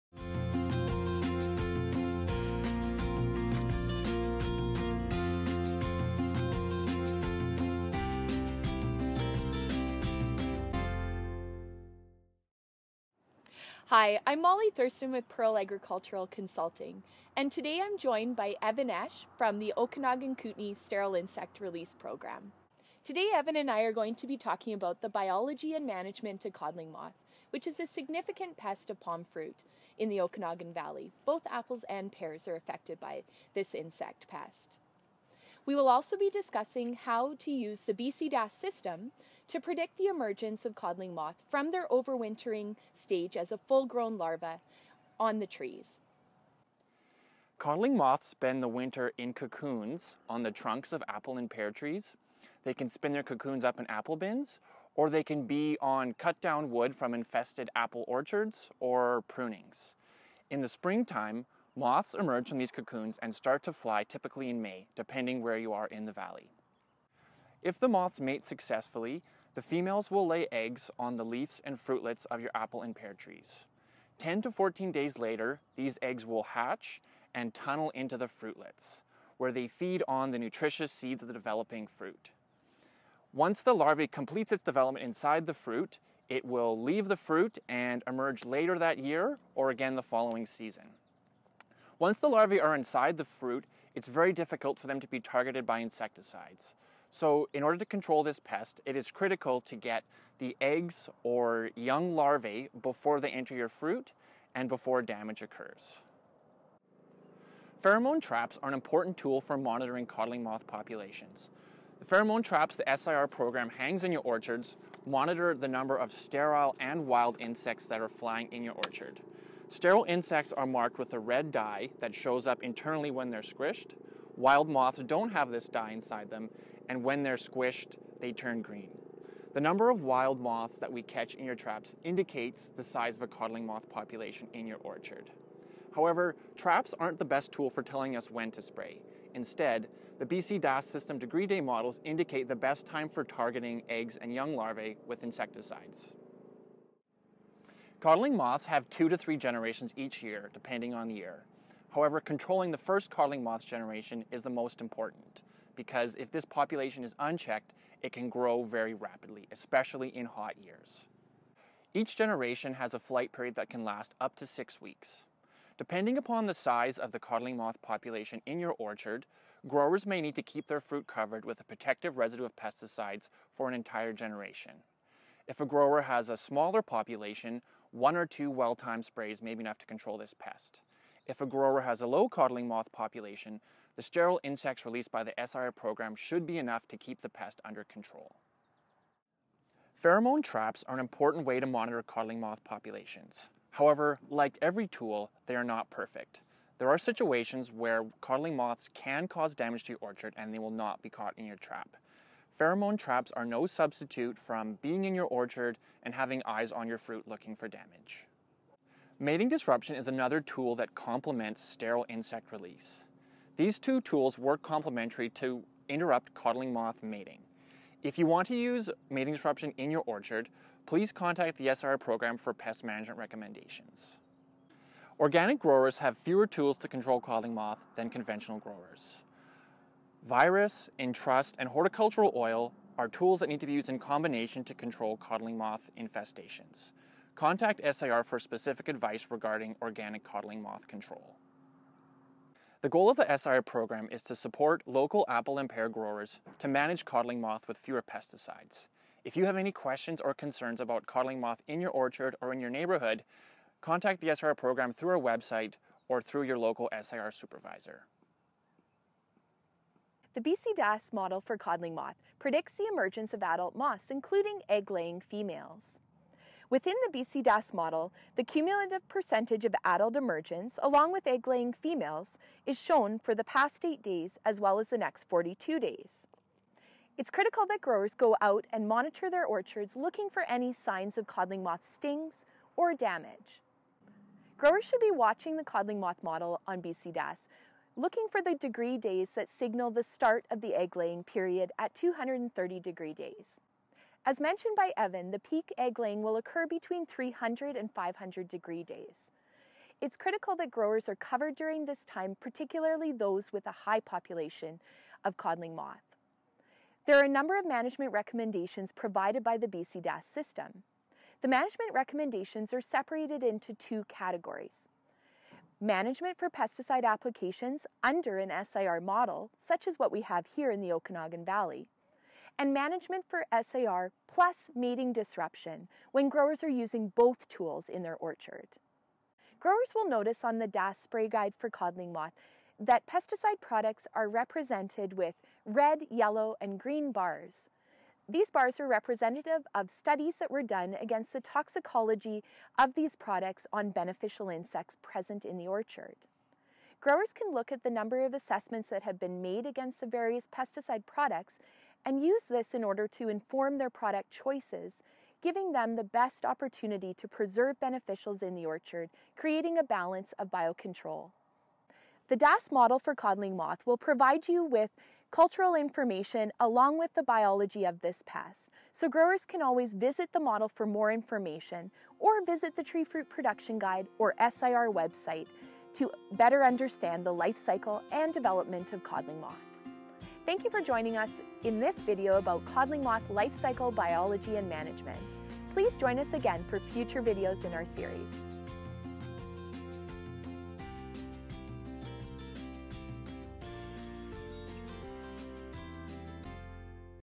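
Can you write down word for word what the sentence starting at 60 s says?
In the springtime, moths emerge from these cocoons and start to fly typically in May, depending where you are in the valley.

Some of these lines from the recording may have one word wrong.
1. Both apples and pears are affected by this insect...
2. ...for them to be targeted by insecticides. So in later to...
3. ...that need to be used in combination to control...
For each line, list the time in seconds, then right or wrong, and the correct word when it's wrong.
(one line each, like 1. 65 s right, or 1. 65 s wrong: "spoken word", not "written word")
1. 31 s right
2. 94 s wrong: "order", not "later"
3. 233 s right.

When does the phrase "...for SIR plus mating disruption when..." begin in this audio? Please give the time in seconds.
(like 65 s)
323 s.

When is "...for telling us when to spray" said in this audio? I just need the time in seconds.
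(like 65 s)
137 s.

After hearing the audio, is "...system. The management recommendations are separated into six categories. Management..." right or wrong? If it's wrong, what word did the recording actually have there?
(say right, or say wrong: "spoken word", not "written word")
wrong: "two", not "six".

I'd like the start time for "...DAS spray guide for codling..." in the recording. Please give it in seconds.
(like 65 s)
330 s.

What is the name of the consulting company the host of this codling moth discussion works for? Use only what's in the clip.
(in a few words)
Pearl Agricultural Consulting.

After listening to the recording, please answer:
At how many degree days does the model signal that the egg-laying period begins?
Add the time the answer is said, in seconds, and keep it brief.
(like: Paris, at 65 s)
230, at 291 s.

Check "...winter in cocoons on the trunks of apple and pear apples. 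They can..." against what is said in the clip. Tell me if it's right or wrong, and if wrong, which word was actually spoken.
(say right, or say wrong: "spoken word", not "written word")
wrong: "trees", not "apples".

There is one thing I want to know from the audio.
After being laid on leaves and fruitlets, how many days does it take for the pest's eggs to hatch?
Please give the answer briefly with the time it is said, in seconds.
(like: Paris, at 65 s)
10 to 14 days, at 74 s.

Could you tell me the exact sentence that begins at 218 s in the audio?
If you want to use mating disruption in your orchard, please contact the SIR program for pest management recommendations.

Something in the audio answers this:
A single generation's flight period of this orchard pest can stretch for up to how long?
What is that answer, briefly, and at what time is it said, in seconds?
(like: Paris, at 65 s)
6 weeks, at 164 s.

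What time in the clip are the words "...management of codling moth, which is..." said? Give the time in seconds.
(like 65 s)
25 s.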